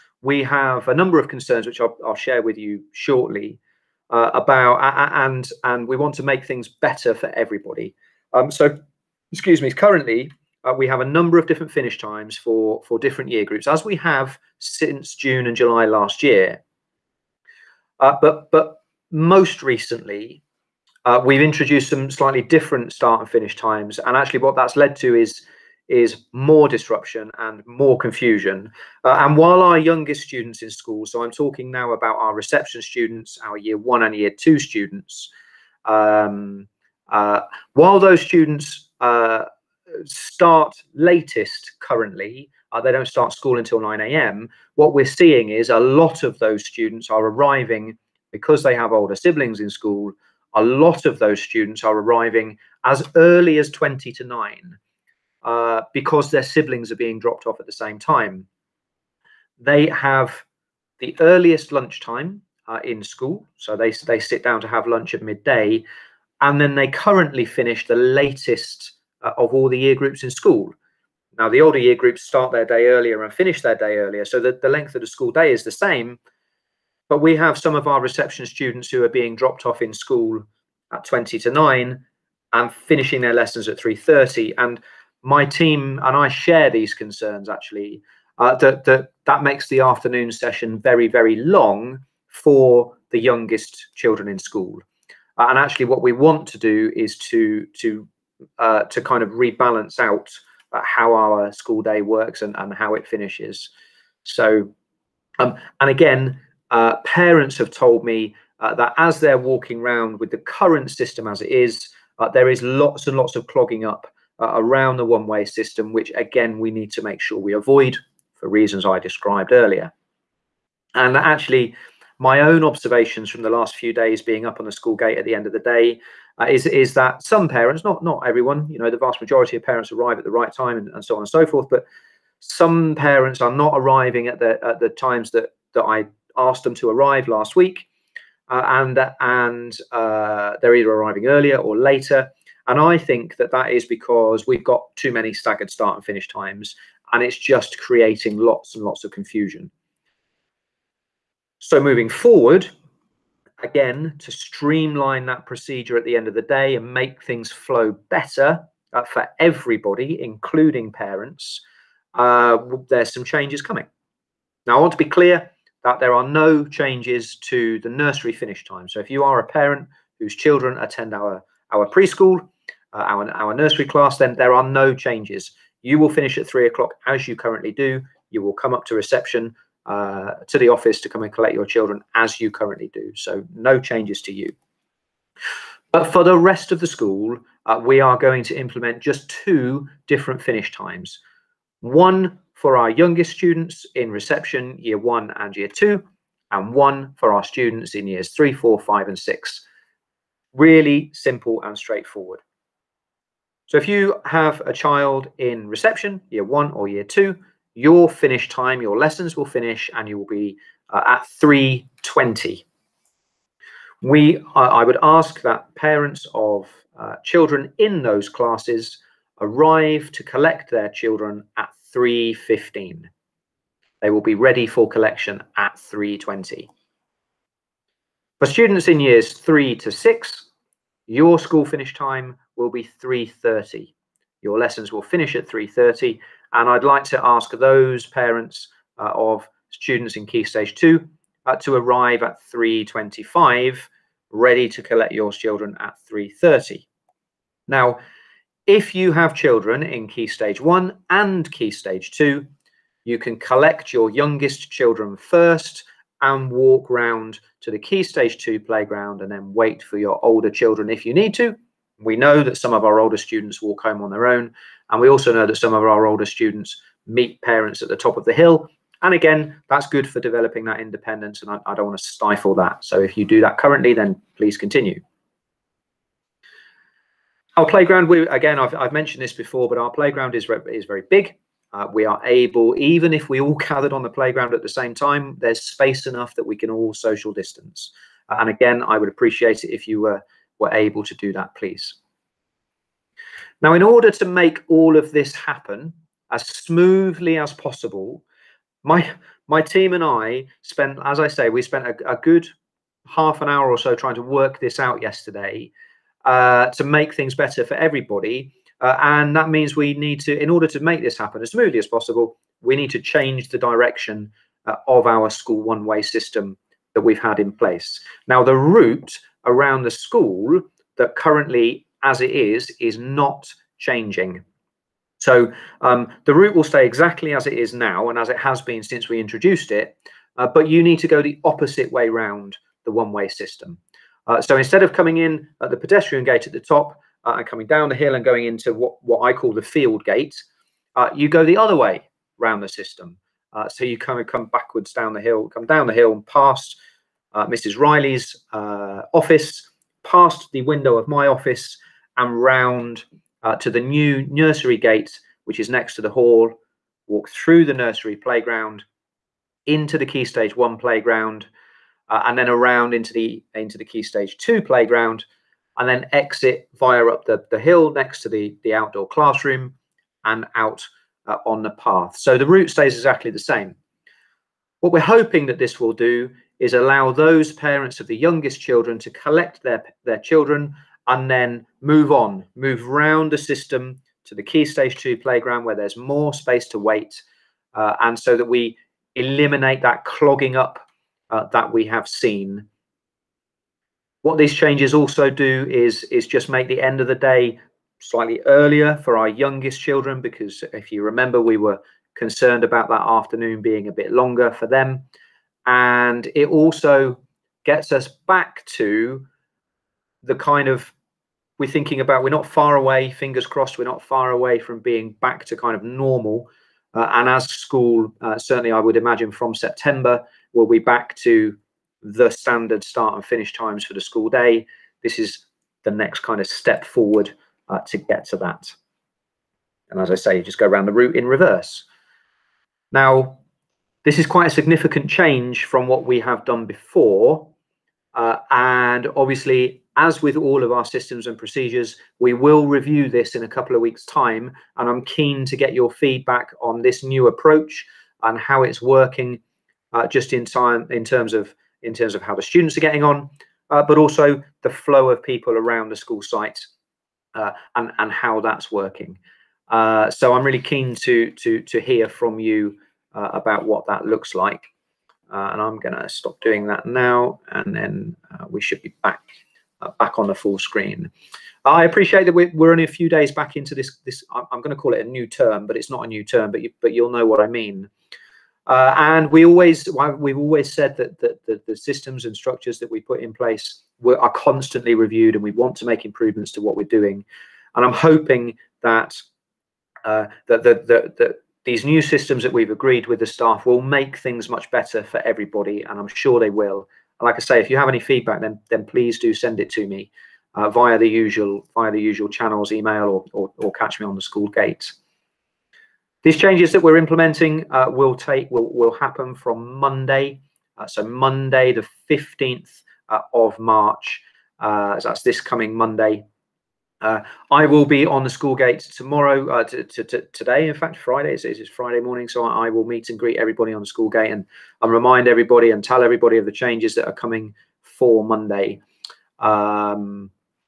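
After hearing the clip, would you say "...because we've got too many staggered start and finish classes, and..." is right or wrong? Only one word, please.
wrong.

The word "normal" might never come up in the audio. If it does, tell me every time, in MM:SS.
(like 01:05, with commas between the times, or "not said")
06:55.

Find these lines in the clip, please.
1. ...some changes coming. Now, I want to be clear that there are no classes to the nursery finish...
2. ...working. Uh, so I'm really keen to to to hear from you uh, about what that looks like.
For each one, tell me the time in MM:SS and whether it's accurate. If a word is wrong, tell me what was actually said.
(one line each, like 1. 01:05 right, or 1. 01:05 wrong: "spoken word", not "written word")
1. 02:43 wrong: "changes", not "classes"
2. 07:38 right.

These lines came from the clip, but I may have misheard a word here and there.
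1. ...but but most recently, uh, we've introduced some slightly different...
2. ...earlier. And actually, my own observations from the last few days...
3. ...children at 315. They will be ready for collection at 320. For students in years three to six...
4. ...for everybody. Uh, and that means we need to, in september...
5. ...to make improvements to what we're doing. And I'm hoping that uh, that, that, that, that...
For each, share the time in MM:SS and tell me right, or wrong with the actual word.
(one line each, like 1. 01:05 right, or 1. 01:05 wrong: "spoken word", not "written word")
1. 00:18 right
2. 01:59 right
3. 03:40 right
4. 05:07 wrong: "order", not "september"
5. 08:05 right.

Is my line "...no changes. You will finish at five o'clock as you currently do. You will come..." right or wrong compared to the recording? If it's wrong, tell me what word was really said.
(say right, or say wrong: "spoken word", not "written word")
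wrong: "three", not "five".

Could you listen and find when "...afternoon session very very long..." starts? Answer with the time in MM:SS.
01:29.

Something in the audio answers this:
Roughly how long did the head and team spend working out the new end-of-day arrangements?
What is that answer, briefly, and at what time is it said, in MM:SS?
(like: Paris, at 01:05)
half an hour, at 05:03.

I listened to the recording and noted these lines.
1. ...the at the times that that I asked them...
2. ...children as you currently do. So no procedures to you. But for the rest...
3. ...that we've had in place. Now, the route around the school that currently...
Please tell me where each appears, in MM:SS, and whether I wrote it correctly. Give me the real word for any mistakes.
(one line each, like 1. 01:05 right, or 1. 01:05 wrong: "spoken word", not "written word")
1. 02:14 right
2. 03:01 wrong: "changes", not "procedures"
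3. 05:16 right.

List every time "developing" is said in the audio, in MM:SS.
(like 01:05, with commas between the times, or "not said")
04:30.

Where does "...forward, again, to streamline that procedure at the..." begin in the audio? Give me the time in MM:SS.
02:32.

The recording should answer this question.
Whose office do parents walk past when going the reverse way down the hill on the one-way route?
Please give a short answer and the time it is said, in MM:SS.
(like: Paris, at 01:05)
Mrs. Riley, at 05:47.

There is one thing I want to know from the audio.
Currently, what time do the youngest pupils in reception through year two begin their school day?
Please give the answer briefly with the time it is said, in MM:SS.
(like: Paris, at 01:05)
9 a.m., at 00:43.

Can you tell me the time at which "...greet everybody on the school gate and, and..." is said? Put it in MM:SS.
08:43.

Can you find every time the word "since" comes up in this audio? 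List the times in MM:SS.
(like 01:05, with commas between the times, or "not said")
00:14, 05:28.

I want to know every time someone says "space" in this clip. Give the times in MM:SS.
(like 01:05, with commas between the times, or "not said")
04:45, 06:26.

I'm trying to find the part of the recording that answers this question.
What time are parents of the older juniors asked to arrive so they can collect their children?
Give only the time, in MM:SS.
04:02.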